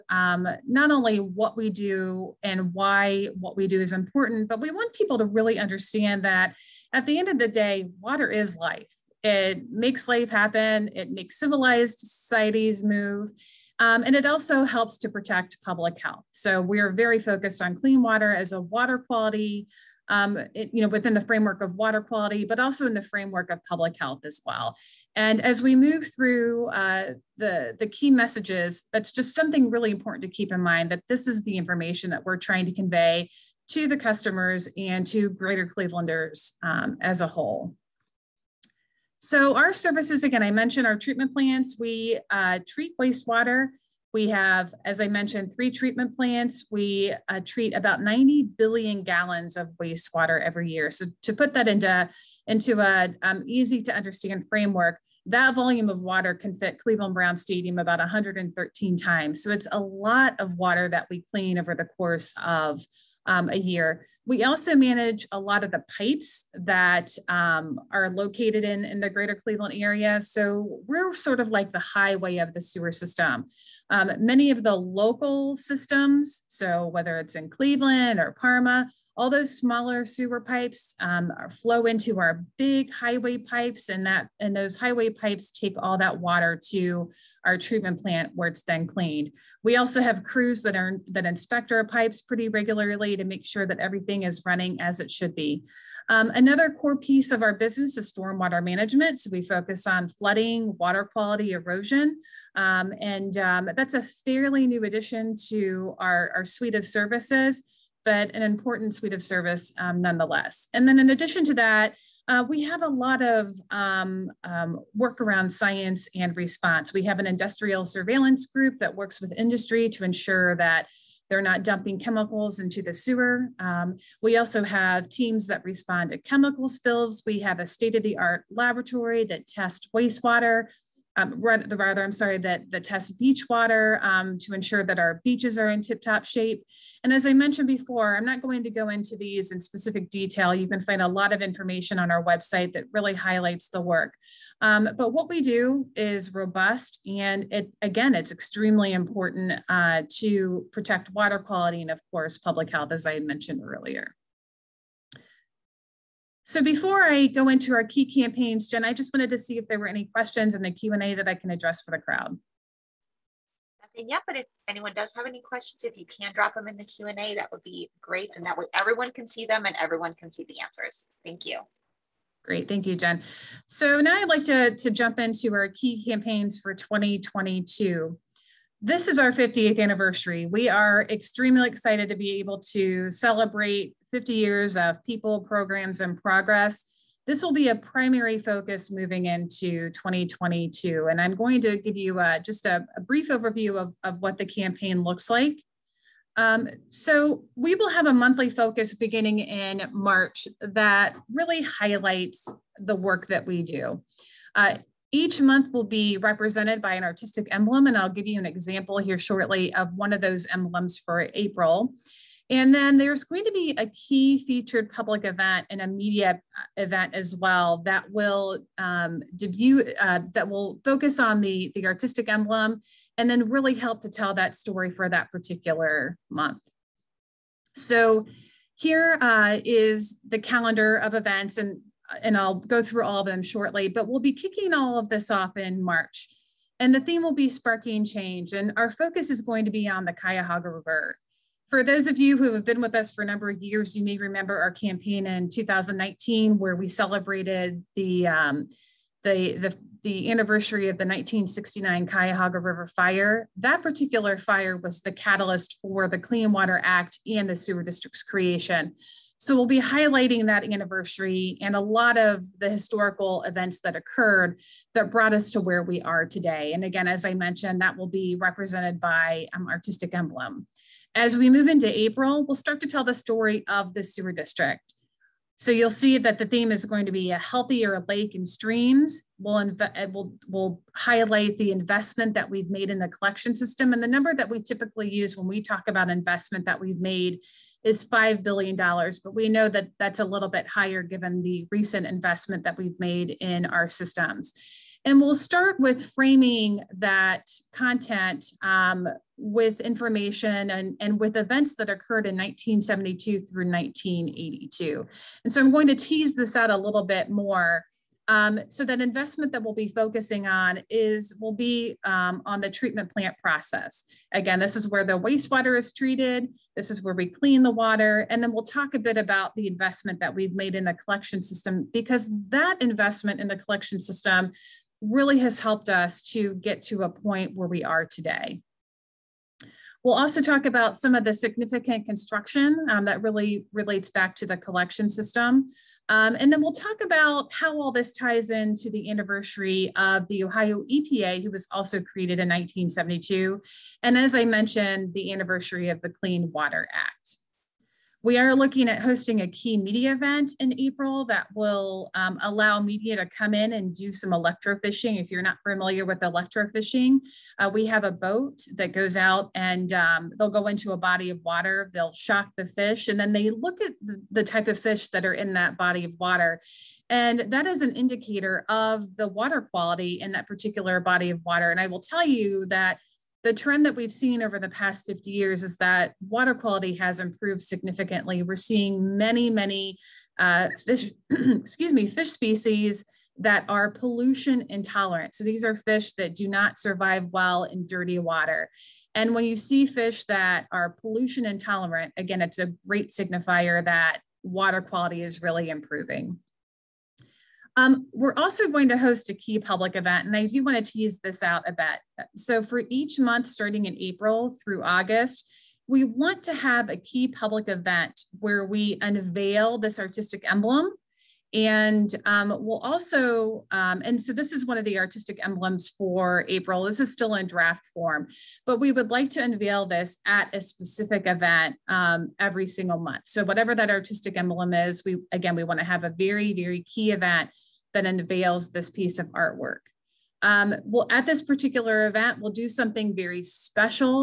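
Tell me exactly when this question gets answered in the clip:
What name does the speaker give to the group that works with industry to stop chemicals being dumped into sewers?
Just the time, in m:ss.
1:57.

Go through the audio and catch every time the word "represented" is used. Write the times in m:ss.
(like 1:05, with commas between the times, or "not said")
3:26, 4:28.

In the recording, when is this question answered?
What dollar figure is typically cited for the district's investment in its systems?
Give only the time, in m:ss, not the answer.
4:48.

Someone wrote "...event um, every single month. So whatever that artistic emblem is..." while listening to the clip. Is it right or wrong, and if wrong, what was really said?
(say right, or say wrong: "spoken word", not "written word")
right.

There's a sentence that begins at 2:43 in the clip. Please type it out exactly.
Nothing yet, but if anyone does have any questions, if you can drop them in the Q&A, that would be great.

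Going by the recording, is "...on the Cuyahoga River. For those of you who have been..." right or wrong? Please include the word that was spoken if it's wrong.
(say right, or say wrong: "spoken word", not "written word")
right.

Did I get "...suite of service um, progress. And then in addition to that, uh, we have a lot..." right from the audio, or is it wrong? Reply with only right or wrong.
wrong.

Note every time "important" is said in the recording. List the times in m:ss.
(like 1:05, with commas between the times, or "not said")
0:03, 0:29, 1:48, 2:28.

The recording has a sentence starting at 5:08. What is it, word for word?
Um, so that investment that we'll be focusing on is will be um, on the treatment plant process.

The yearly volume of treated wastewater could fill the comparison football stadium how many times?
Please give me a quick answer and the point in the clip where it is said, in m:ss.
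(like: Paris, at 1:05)
113, at 0:57.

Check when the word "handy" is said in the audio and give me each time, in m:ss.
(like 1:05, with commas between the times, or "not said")
not said.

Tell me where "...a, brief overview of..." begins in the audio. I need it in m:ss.
3:12.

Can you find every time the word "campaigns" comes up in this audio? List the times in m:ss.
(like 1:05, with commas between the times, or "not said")
2:38, 2:56, 3:14, 4:04.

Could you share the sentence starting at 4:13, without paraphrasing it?
That particular fire was the catalyst for the Clean Water Act and the sewer district's creation.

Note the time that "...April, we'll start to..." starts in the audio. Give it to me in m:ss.
4:31.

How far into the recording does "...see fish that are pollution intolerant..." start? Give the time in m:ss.
6:29.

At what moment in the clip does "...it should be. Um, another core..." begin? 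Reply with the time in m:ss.
1:34.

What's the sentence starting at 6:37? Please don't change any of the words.
Um, we're also going to host a key public event, and I do want to tease this out a bit.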